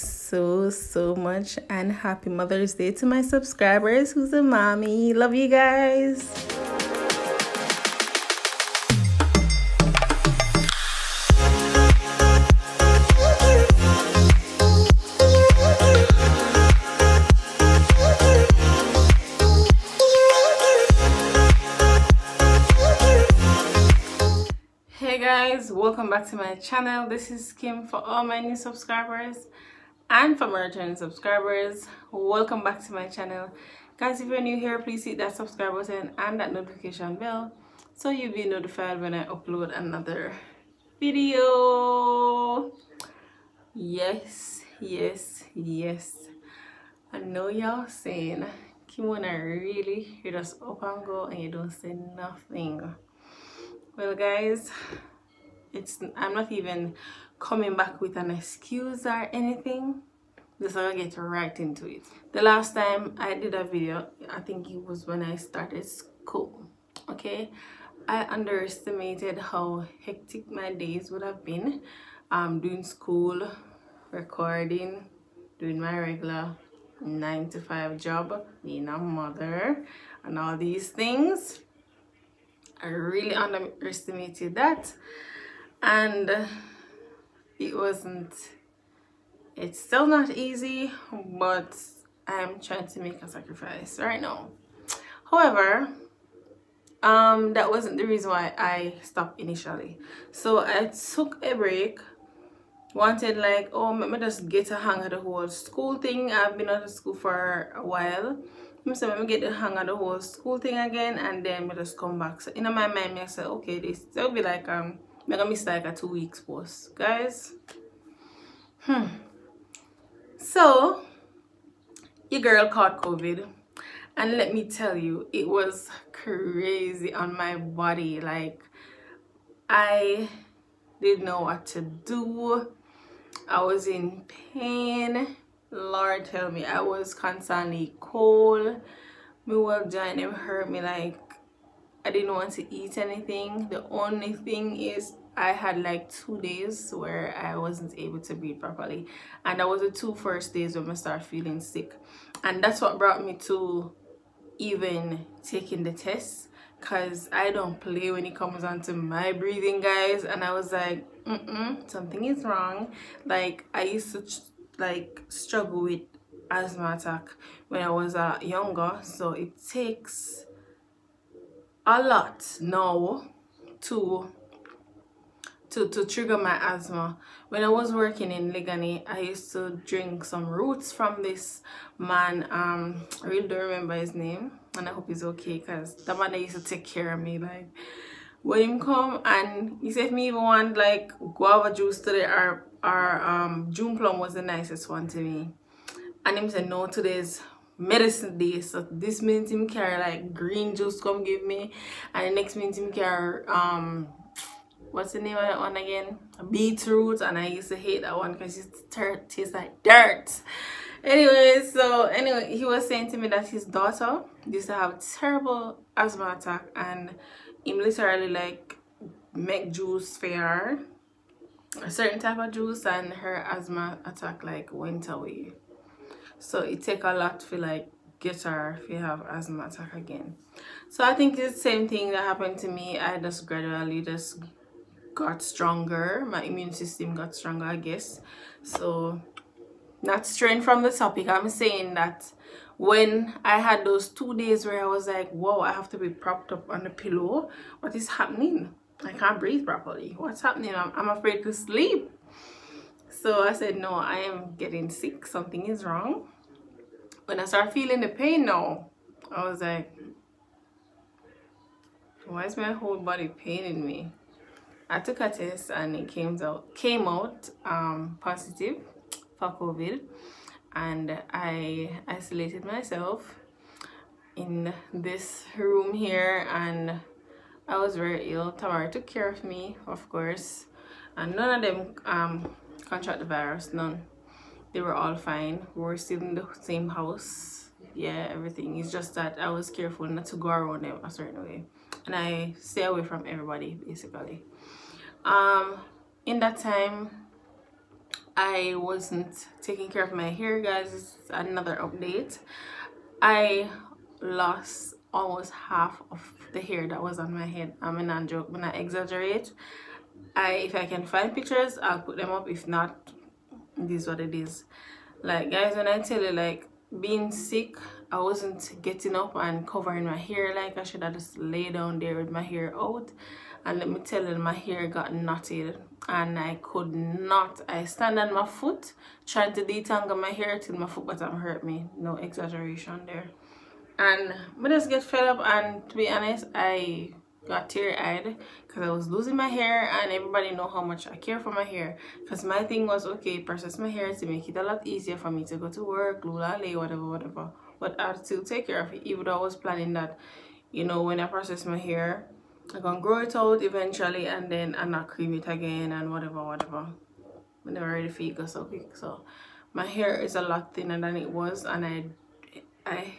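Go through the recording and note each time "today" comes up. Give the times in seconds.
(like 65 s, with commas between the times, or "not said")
191 s, 196 s.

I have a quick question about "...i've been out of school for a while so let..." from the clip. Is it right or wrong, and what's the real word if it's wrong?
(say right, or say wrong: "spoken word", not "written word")
right.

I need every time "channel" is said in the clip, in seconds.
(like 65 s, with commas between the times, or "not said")
26 s, 33 s.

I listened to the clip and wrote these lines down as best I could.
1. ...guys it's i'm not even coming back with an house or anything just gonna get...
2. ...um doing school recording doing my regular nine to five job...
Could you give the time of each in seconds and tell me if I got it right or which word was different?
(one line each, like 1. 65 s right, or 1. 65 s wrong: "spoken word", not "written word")
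1. 54 s wrong: "excuse", not "house"
2. 72 s right.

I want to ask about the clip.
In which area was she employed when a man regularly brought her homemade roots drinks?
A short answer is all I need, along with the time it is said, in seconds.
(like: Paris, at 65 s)
Liguanea, at 178 s.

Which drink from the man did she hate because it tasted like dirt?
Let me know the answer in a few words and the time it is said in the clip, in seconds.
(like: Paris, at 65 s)
beetroot, at 206 s.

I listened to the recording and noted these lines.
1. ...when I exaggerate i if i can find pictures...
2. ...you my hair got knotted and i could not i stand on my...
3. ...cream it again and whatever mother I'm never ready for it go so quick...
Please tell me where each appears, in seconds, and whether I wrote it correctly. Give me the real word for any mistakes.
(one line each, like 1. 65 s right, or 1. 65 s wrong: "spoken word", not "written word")
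1. 308 s right
2. 324 s right
3. 355 s wrong: "whatever", not "mother".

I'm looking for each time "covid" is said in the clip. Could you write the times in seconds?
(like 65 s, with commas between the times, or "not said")
123 s, 269 s.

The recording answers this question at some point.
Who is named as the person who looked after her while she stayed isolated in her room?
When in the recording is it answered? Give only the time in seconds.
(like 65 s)
278 s.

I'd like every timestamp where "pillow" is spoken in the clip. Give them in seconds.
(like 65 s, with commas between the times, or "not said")
246 s.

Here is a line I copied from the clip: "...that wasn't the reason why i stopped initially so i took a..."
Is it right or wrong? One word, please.
right.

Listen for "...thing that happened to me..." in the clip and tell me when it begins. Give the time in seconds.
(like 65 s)
231 s.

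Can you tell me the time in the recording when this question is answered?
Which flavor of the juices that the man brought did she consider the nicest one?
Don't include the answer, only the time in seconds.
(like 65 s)
193 s.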